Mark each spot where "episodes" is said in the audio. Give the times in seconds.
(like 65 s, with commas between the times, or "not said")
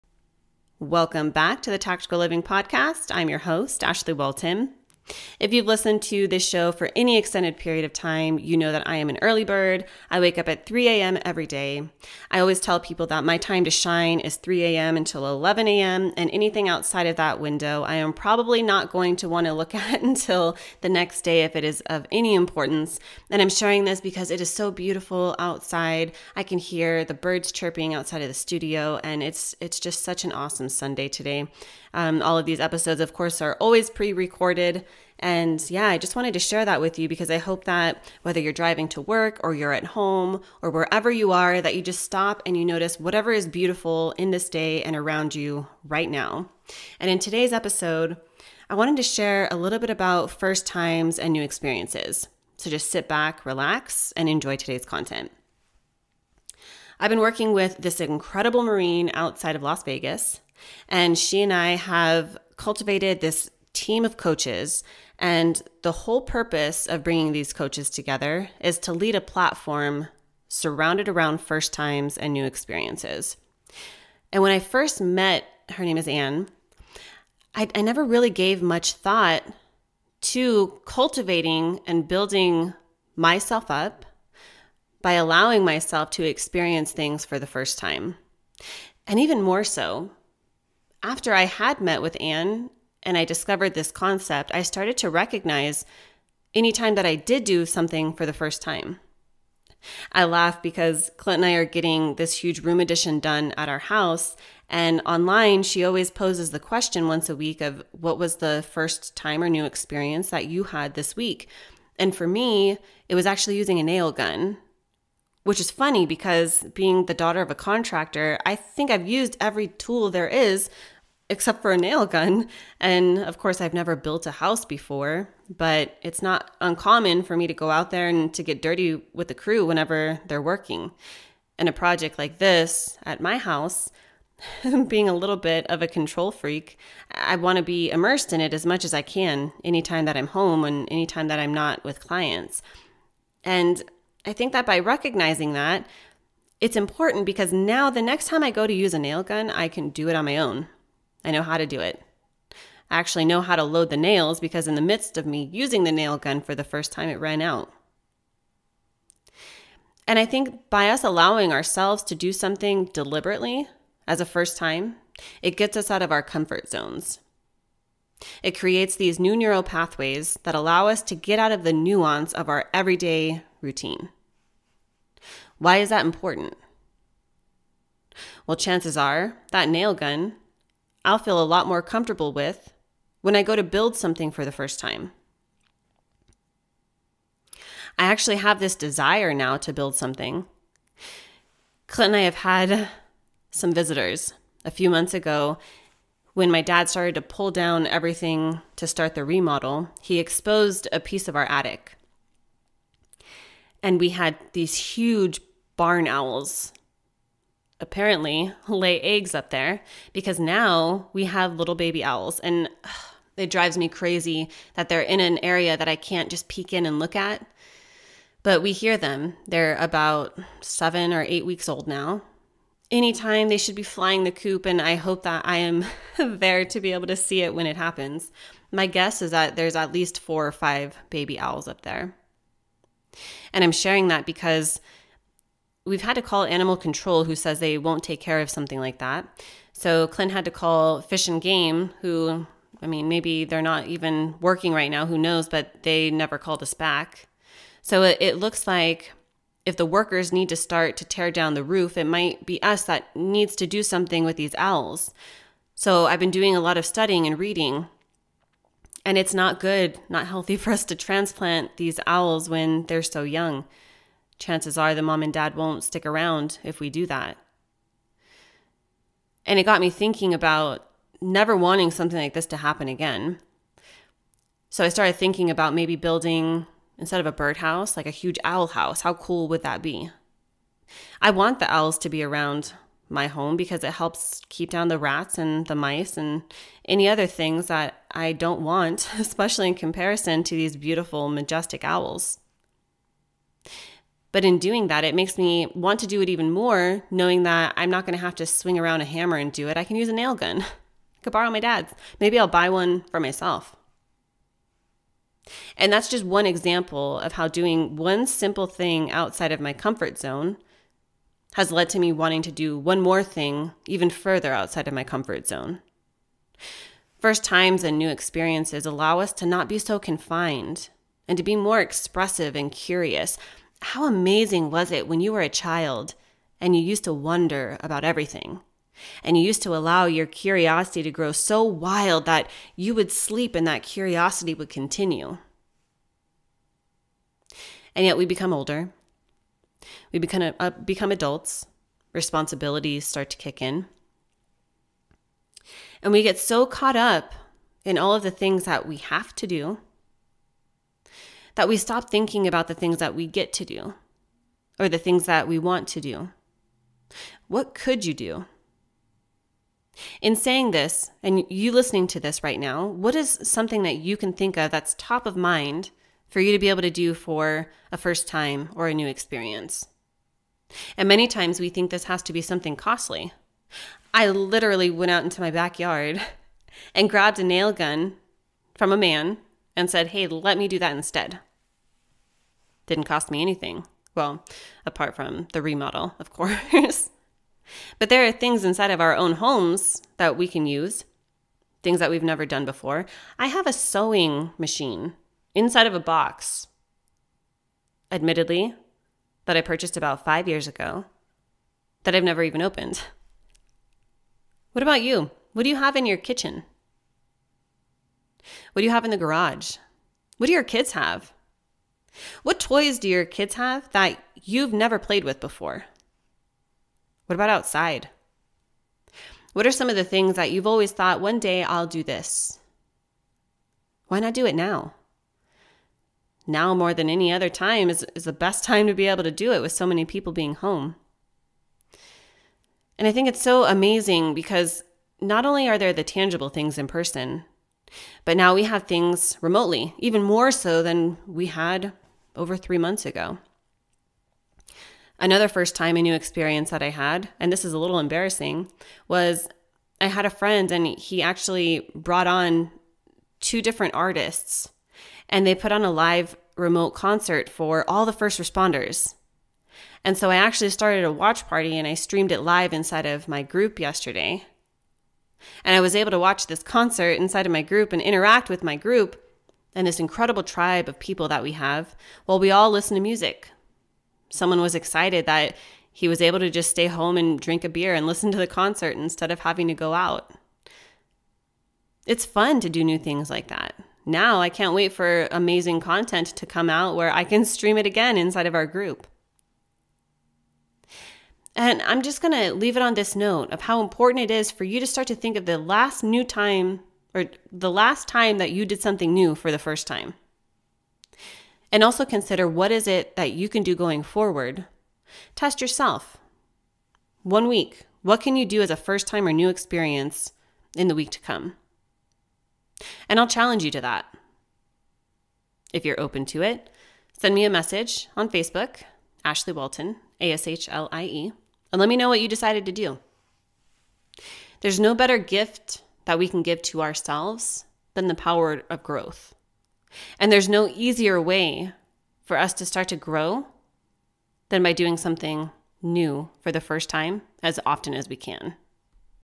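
32 s, 47 s.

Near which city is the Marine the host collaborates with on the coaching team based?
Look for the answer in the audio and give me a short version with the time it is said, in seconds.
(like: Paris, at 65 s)
Las Vegas, at 59 s.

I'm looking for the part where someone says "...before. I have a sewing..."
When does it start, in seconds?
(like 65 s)
392 s.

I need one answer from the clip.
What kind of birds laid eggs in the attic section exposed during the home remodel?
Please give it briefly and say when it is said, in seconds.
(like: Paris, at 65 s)
barn owls, at 205 s.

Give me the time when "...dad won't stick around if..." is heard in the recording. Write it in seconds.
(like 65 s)
265 s.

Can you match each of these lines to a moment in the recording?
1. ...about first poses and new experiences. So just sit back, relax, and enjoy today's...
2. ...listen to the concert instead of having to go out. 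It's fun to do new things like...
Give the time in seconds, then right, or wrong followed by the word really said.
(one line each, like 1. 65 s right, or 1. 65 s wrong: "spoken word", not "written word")
1. 49 s wrong: "times", not "poses"
2. 478 s right.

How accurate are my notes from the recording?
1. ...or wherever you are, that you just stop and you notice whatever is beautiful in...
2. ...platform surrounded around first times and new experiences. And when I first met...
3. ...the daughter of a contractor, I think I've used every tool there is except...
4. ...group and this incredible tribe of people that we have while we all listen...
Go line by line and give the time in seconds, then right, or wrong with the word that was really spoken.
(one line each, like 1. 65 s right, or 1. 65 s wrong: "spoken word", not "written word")
1. 40 s right
2. 69 s right
3. 117 s right
4. 468 s right.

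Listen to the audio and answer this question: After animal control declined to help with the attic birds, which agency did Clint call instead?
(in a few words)
Fish and Game.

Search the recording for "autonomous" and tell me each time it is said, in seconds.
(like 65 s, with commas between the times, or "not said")
not said.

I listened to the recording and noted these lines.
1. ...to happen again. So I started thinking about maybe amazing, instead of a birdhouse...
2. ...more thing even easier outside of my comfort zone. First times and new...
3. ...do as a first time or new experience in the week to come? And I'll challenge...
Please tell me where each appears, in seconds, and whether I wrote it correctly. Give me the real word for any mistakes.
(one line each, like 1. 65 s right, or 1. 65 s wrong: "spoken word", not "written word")
1. 272 s wrong: "building", not "amazing"
2. 313 s wrong: "further", not "easier"
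3. 508 s right.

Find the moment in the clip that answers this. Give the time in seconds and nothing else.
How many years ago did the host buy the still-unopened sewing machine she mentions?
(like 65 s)
400 s.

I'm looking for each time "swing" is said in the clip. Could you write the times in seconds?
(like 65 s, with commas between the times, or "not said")
298 s.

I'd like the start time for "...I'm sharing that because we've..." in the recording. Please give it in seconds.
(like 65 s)
233 s.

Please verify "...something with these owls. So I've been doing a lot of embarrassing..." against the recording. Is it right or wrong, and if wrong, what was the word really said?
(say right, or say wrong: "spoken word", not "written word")
wrong: "studying", not "embarrassing".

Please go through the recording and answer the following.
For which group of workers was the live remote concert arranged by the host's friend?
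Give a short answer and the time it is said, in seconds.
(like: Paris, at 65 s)
first responders, at 458 s.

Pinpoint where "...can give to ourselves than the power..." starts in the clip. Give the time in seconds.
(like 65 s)
526 s.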